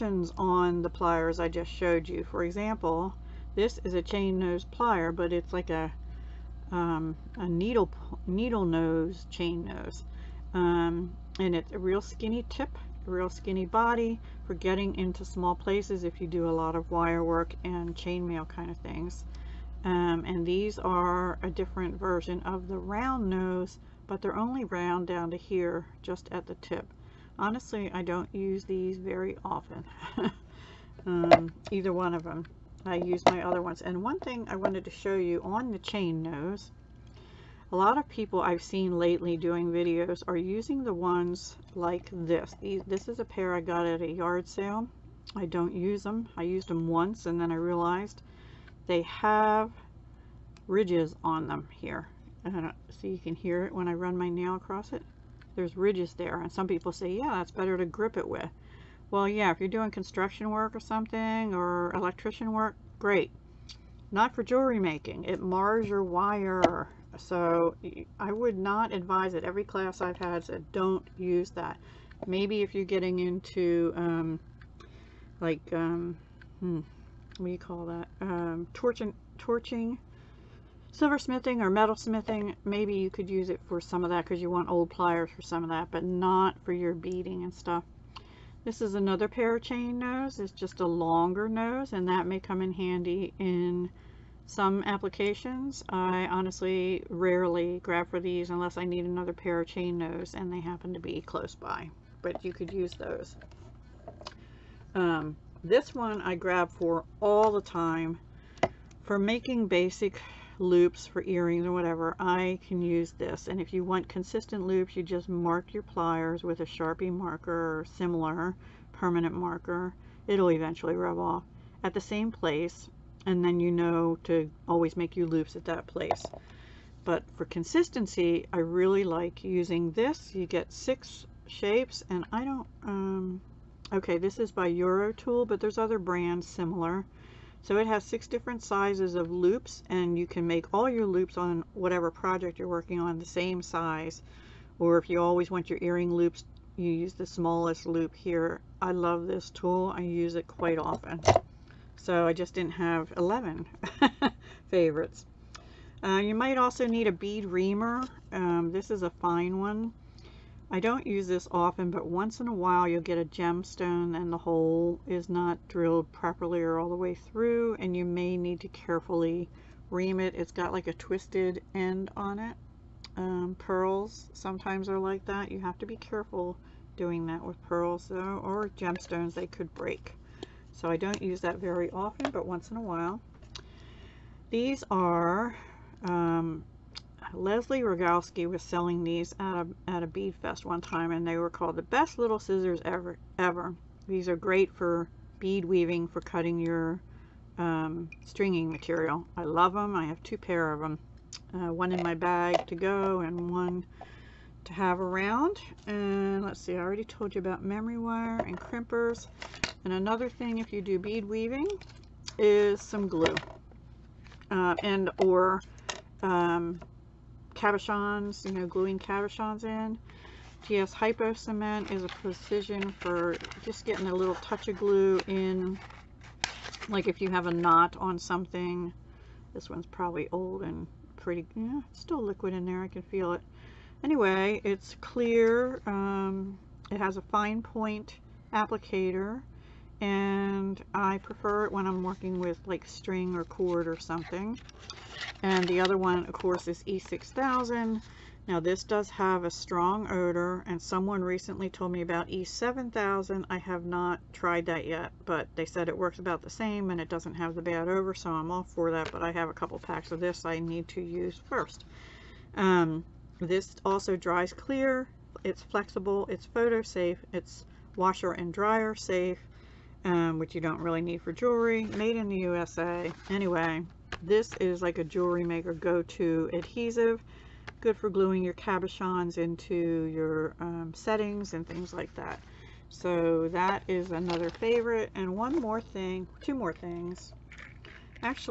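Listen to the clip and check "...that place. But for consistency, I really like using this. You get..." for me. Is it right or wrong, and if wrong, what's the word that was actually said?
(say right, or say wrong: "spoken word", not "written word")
right.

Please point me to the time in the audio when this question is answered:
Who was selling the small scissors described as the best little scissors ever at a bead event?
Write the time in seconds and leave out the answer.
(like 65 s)
187 s.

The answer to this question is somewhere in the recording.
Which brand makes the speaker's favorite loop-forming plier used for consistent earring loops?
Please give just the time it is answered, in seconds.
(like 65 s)
134 s.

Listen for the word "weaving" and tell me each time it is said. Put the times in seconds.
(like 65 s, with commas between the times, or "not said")
195 s, 211 s.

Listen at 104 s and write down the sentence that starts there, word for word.
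Um, this one I grab for all the time for making basic loops for earrings or whatever, I can use this.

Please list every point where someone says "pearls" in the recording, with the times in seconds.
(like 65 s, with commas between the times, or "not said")
173 s, 177 s.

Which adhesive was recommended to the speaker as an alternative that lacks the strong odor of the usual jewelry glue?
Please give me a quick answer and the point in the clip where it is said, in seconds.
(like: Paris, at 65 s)
E7000, at 252 s.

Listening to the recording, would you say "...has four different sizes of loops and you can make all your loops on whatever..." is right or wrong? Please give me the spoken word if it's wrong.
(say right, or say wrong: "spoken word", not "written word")
wrong: "six", not "four".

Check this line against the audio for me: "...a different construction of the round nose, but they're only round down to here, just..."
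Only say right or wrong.
wrong.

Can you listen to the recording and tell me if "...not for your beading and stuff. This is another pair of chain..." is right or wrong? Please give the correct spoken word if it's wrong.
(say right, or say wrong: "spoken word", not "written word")
right.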